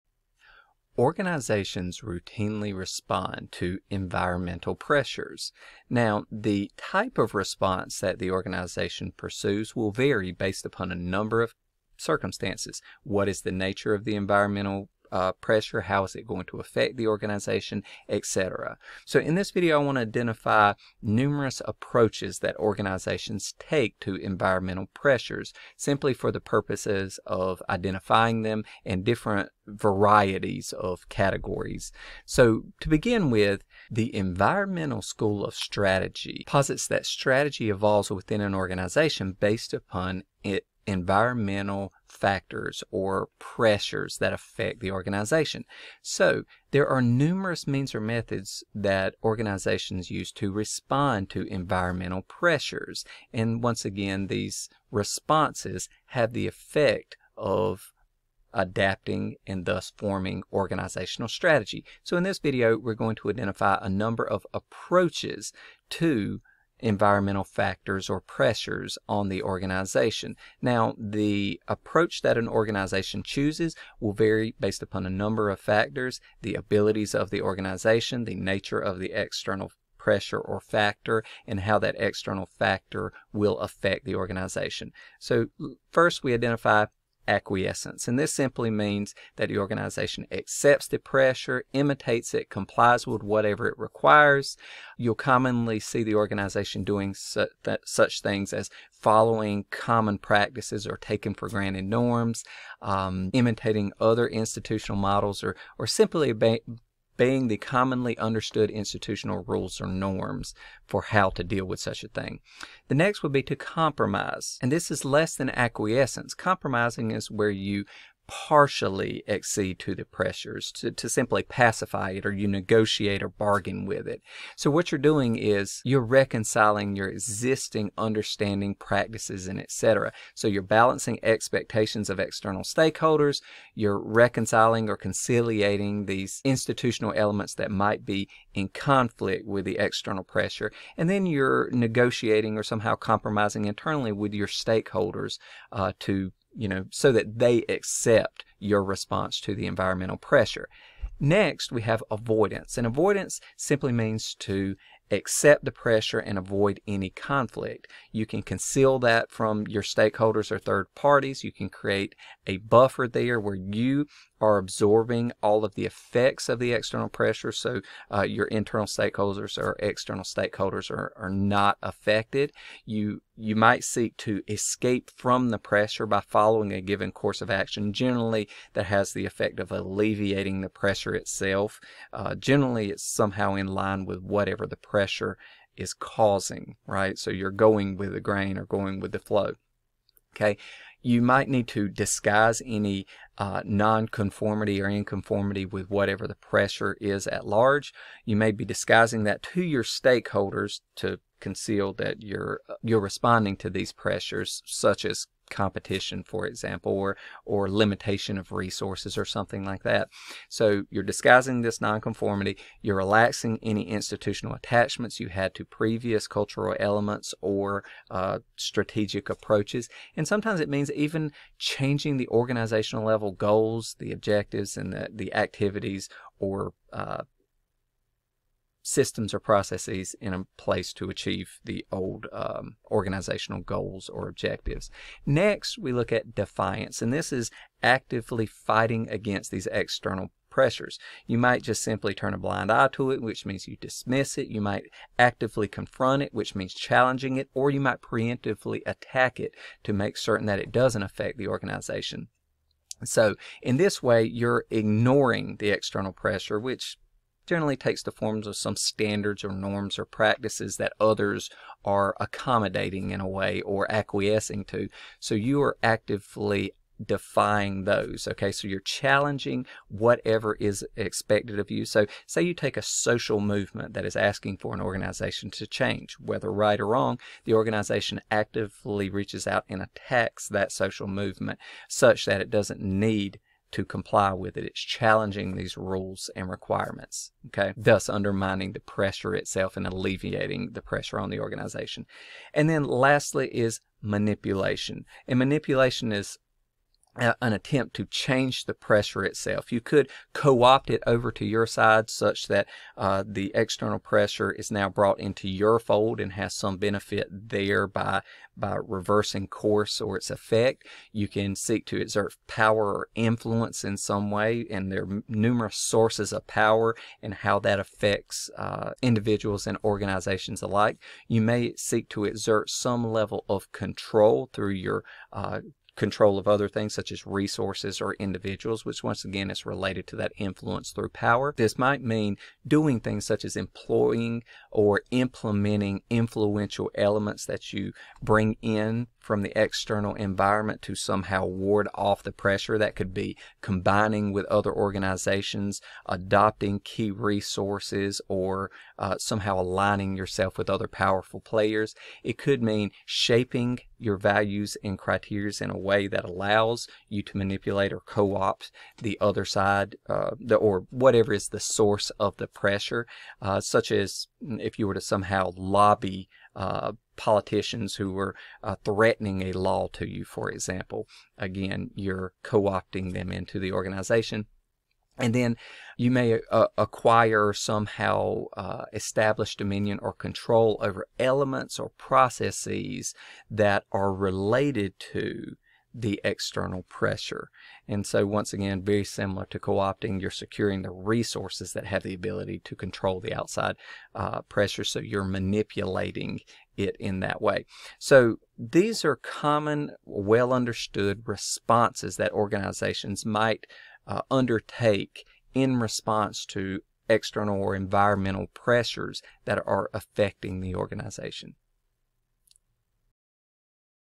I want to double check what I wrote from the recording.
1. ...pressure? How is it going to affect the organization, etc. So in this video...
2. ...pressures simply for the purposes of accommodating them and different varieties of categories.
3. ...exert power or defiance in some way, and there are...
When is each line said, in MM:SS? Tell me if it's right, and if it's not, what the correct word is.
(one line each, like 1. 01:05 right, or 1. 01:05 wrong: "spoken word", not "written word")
1. 00:15 right
2. 00:24 wrong: "identifying", not "accommodating"
3. 05:11 wrong: "influence", not "defiance".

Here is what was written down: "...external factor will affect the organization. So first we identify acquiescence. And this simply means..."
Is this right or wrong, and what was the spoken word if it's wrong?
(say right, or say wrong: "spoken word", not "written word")
right.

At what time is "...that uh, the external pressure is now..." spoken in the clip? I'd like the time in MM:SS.
05:02.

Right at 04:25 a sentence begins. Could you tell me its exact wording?
So you are actively defying those.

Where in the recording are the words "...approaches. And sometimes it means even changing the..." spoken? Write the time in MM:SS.
03:39.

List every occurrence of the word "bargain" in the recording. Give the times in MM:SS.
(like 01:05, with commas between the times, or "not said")
02:03.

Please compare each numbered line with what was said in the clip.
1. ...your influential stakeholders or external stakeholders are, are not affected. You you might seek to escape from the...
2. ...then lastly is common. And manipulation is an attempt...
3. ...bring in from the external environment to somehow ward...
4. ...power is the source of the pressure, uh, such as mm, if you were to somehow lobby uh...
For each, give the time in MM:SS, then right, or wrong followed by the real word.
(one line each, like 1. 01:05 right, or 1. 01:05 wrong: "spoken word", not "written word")
1. 02:48 wrong: "internal", not "influential"
2. 04:52 wrong: "manipulation", not "common"
3. 05:38 right
4. 06:00 wrong: "whatever", not "power".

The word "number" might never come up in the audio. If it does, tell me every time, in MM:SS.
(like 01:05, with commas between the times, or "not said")
00:10, 01:03, 01:15.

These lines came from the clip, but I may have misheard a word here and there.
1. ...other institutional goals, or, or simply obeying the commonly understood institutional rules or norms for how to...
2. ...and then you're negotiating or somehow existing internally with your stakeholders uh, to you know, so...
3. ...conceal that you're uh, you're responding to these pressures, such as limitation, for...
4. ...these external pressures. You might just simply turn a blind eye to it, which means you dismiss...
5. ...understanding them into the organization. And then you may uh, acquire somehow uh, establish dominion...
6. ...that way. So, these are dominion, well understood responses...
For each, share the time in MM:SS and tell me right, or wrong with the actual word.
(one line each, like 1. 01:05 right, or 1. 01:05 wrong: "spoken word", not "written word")
1. 01:43 wrong: "models", not "goals"
2. 02:20 wrong: "compromising", not "existing"
3. 03:21 wrong: "competition", not "limitation"
4. 03:59 right
5. 06:12 wrong: "opting", not "understanding"
6. 06:37 wrong: "common", not "dominion".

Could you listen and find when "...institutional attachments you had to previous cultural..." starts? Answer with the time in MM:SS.
03:33.